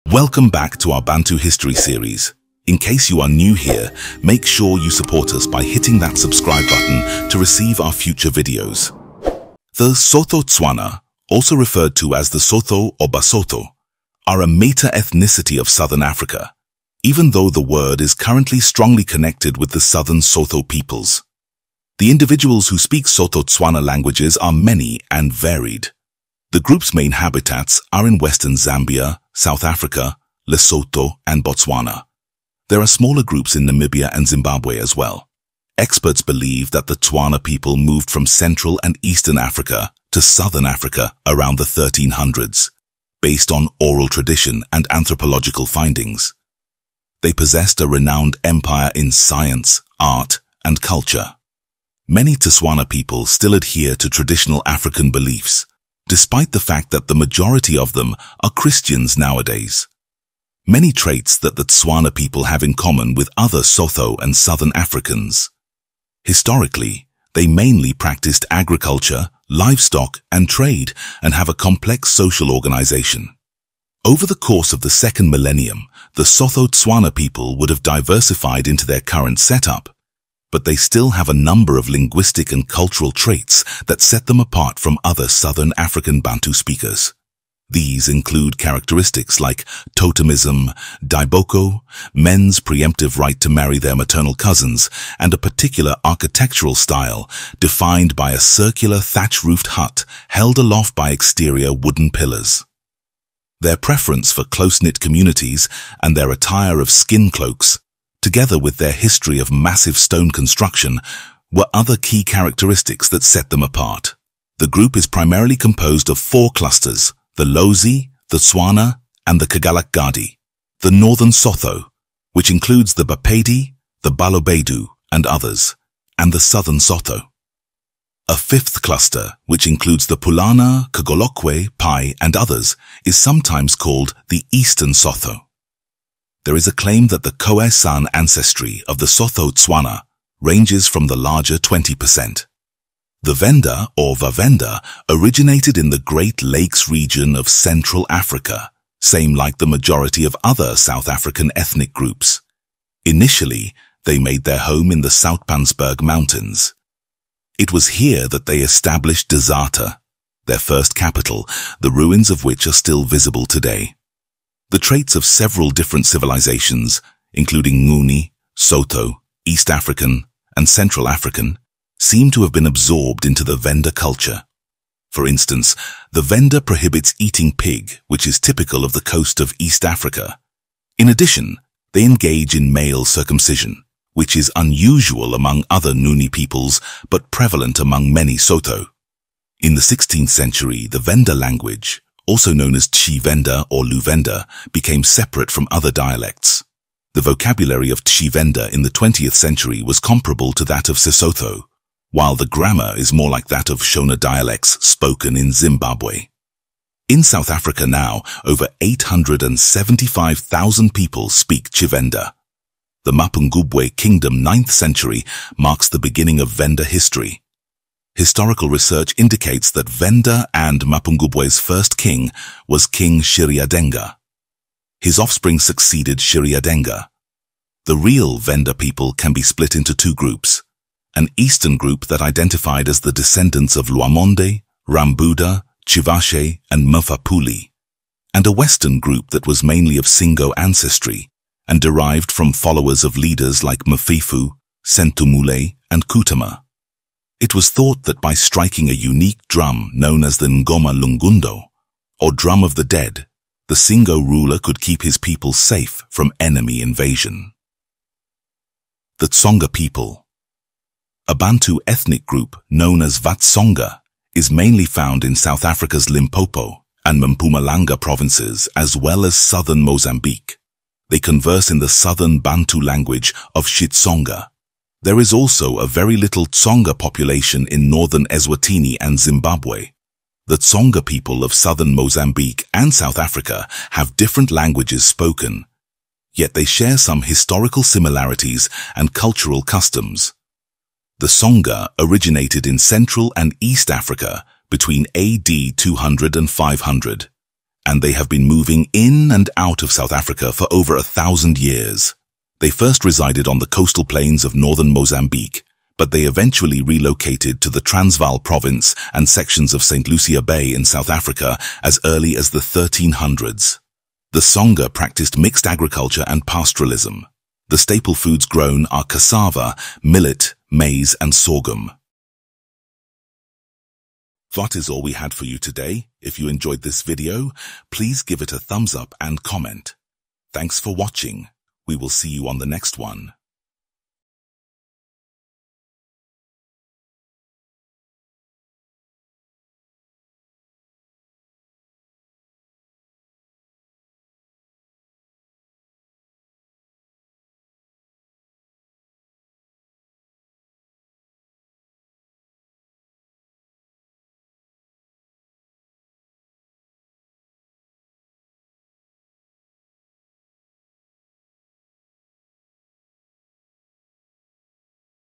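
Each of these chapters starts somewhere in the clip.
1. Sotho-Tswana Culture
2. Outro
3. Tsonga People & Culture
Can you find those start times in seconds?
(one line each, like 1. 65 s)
1. 10 s
2. 325 s
3. 260 s.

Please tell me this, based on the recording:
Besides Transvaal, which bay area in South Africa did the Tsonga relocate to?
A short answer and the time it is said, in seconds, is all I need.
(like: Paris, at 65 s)
St. Lucia Bay, at 309 s.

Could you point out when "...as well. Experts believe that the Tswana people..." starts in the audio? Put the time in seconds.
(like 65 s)
34 s.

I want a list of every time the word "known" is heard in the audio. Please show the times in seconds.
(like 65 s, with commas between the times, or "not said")
192 s, 249 s, 262 s.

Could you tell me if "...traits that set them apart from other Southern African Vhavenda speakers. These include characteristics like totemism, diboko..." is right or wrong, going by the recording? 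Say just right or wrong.
wrong.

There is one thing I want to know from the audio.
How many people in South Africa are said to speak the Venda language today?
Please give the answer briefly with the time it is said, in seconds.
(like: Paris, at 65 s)
875,000, at 208 s.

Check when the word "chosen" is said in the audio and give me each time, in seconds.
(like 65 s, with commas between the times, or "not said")
not said.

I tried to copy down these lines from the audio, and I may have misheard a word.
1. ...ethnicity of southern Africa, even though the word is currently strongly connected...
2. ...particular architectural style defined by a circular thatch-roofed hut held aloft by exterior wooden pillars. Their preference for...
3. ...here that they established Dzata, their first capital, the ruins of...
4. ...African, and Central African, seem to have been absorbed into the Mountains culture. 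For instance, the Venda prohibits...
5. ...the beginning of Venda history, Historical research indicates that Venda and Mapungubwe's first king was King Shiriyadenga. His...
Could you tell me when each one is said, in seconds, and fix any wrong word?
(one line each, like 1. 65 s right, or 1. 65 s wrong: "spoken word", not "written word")
1. 14 s right
2. 95 s right
3. 158 s right
4. 169 s wrong: "Venda", not "Mountains"
5. 215 s right.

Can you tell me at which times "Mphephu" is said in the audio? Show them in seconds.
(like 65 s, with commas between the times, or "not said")
243 s.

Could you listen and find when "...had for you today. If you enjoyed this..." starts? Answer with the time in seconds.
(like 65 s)
325 s.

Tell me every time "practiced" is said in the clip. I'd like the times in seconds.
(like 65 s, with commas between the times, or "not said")
67 s, 314 s.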